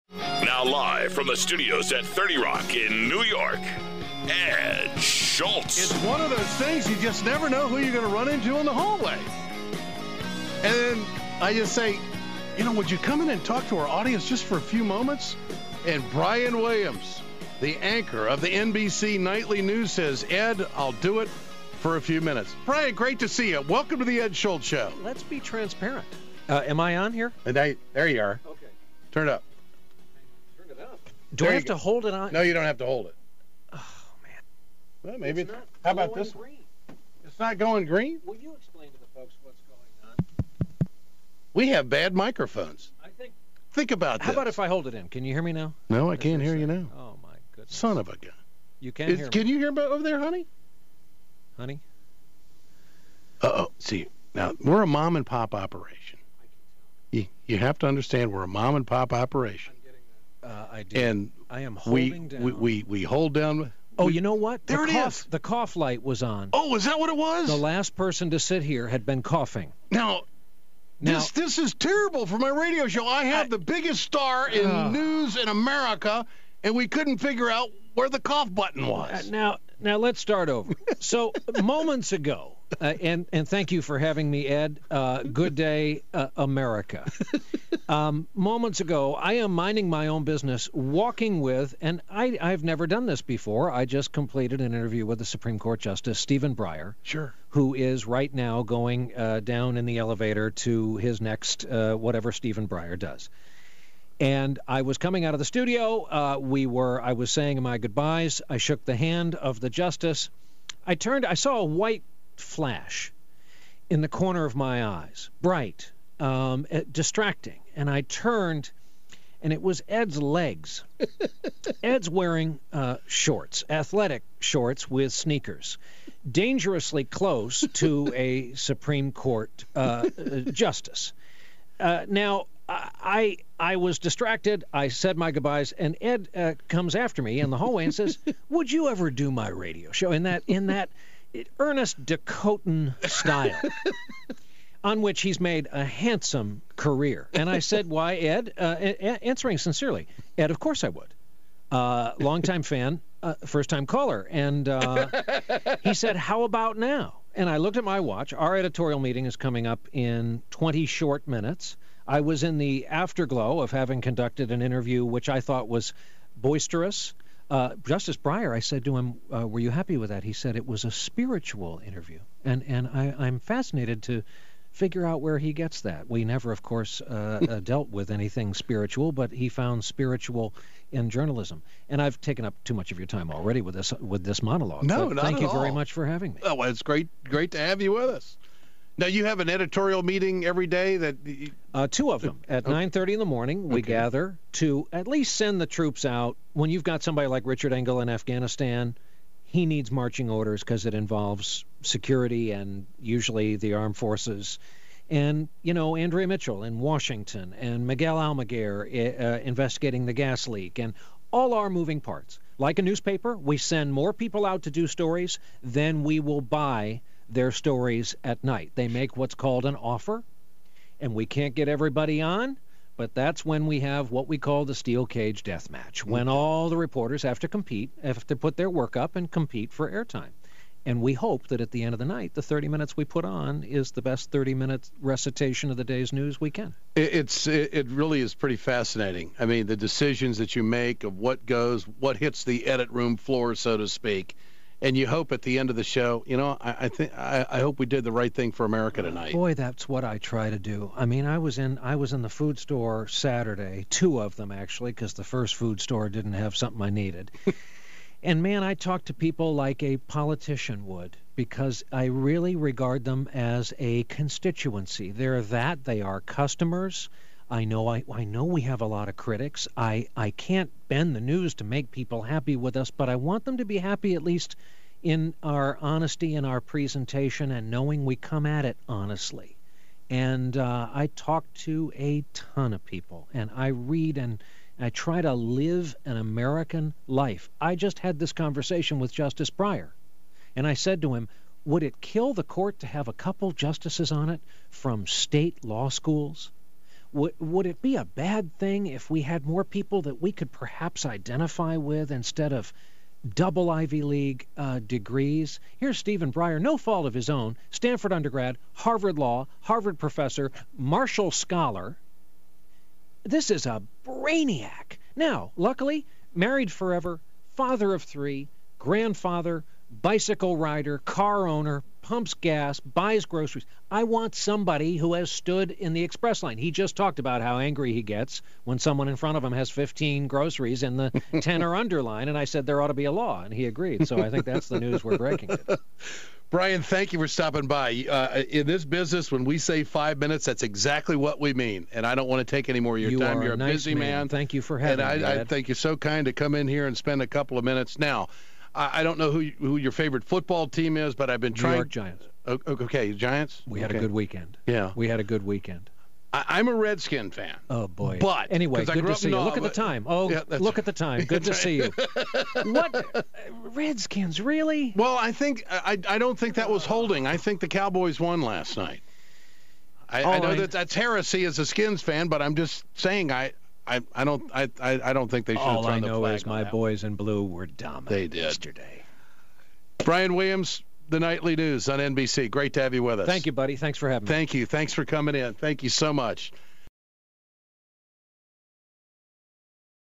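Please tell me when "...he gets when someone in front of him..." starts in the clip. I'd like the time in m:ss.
5:27.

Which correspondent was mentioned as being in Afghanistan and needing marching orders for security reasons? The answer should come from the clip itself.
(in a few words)
Richard Engel.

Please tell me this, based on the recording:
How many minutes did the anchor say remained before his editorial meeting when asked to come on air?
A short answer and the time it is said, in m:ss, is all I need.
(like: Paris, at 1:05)
20, at 2:40.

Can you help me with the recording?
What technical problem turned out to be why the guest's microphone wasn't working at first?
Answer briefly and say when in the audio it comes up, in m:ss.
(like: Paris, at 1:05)
The cough light was on, at 1:05.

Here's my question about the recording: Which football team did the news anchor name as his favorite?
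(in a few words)
New York Giants.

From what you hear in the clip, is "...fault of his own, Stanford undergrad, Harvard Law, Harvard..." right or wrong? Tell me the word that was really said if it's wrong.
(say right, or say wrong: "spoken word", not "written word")
right.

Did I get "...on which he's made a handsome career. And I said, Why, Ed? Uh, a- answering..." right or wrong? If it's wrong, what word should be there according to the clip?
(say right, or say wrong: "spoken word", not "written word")
right.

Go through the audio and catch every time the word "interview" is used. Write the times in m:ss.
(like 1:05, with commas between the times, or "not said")
1:34, 2:44, 2:51.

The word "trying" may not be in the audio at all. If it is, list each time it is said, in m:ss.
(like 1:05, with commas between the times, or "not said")
5:51.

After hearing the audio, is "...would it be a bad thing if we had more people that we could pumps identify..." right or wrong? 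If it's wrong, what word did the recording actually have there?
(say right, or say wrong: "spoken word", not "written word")
wrong: "perhaps", not "pumps".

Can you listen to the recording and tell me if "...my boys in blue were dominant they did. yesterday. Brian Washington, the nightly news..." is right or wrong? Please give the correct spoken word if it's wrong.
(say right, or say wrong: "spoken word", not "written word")
wrong: "Williams", not "Washington".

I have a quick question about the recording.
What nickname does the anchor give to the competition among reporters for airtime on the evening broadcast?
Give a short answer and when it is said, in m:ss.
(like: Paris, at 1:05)
Steel cage death match, at 3:44.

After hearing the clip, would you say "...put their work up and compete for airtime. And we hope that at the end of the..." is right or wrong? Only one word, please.
right.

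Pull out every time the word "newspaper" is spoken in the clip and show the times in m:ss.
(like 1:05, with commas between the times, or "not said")
3:32.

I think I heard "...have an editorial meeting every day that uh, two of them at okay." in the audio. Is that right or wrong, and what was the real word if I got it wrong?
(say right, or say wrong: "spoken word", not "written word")
right.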